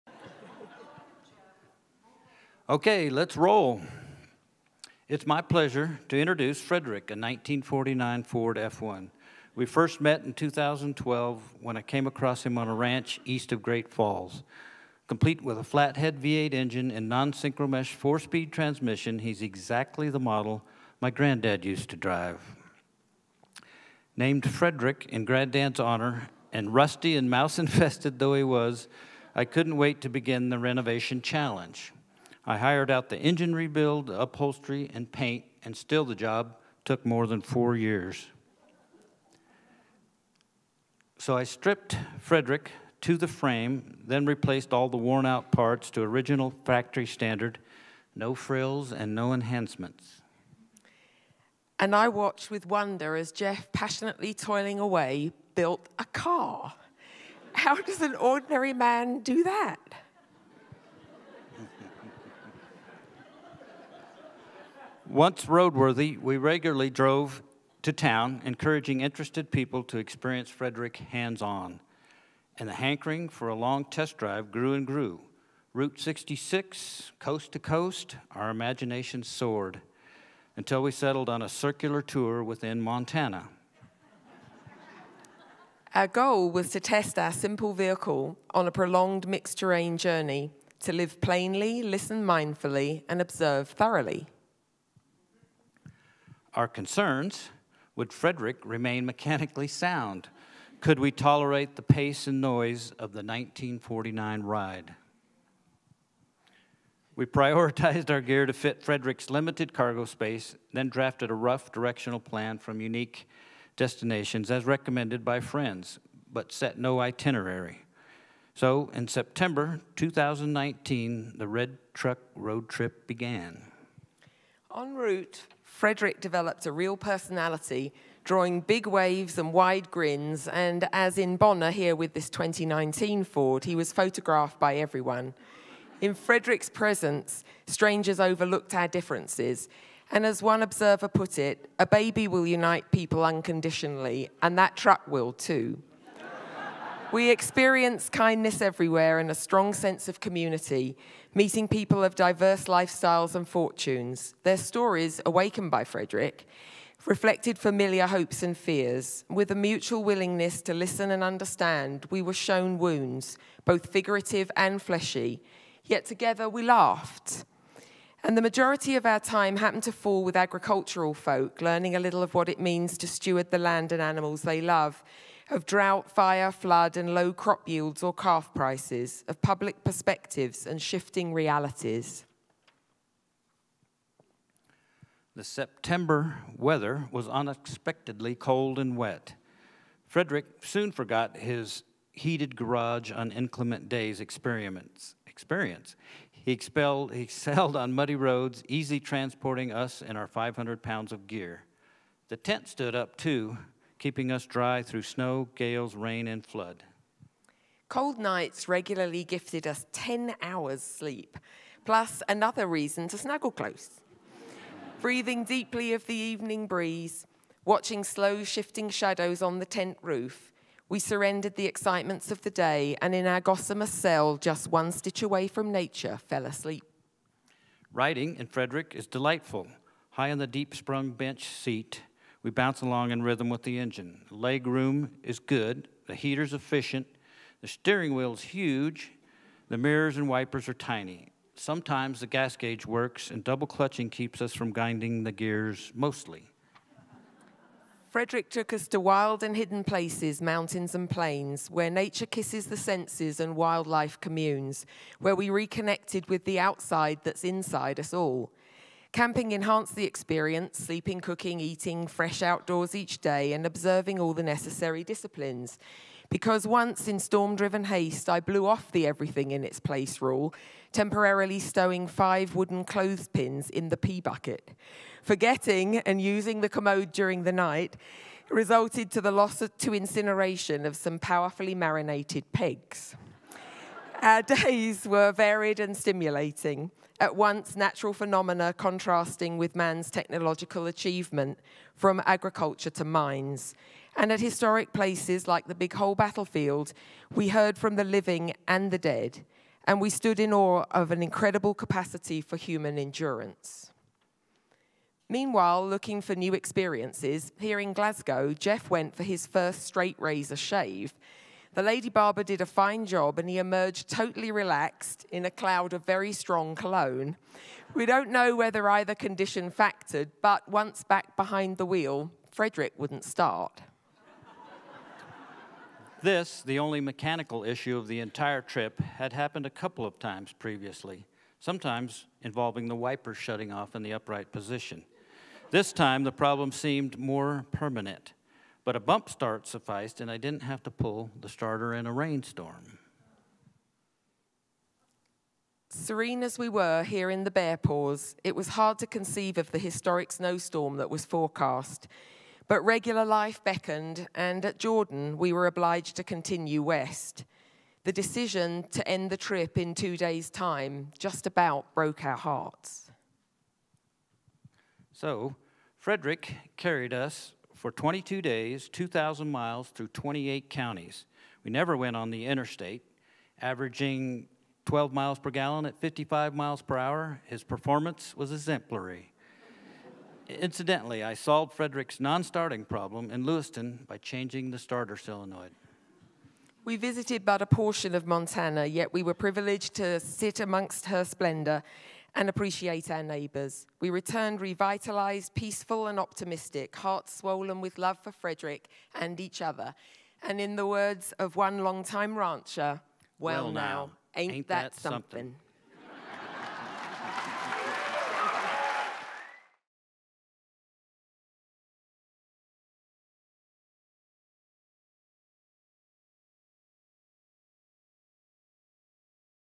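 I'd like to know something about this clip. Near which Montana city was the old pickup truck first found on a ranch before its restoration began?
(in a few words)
Great Falls.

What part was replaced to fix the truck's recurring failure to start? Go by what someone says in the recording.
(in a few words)
starter solenoid.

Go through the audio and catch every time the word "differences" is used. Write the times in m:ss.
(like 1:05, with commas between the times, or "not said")
2:18.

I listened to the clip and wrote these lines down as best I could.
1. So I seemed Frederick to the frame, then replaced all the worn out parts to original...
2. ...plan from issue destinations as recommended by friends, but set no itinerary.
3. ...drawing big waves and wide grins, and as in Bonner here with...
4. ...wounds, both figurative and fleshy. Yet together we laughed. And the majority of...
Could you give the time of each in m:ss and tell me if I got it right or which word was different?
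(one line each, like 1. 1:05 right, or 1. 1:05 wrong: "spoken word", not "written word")
1. 0:41 wrong: "stripped", not "seemed"
2. 1:52 wrong: "unique", not "issue"
3. 2:08 right
4. 2:42 right.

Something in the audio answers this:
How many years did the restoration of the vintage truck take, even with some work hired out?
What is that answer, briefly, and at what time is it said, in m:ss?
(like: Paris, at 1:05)
4, at 0:37.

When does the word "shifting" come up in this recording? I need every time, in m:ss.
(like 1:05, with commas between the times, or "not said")
3:00, 3:38.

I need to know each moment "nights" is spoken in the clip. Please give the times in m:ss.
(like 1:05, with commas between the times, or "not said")
3:28, 4:37.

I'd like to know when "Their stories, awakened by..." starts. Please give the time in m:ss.
2:34.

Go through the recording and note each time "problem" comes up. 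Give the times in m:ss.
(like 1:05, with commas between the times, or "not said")
5:36, 6:22.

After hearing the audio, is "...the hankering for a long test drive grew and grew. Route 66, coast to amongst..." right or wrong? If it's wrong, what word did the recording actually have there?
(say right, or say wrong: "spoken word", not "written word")
wrong: "coast", not "amongst".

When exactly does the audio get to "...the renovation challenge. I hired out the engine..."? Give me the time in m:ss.
0:30.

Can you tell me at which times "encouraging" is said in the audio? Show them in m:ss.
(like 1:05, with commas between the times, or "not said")
1:08.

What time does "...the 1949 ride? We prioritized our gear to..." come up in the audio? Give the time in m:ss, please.
1:43.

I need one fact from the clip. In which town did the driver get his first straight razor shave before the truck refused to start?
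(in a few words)
Glasgow.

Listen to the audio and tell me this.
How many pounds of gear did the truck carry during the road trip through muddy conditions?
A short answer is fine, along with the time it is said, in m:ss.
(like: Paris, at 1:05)
500, at 3:20.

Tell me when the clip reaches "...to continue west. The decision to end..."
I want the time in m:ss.
5:56.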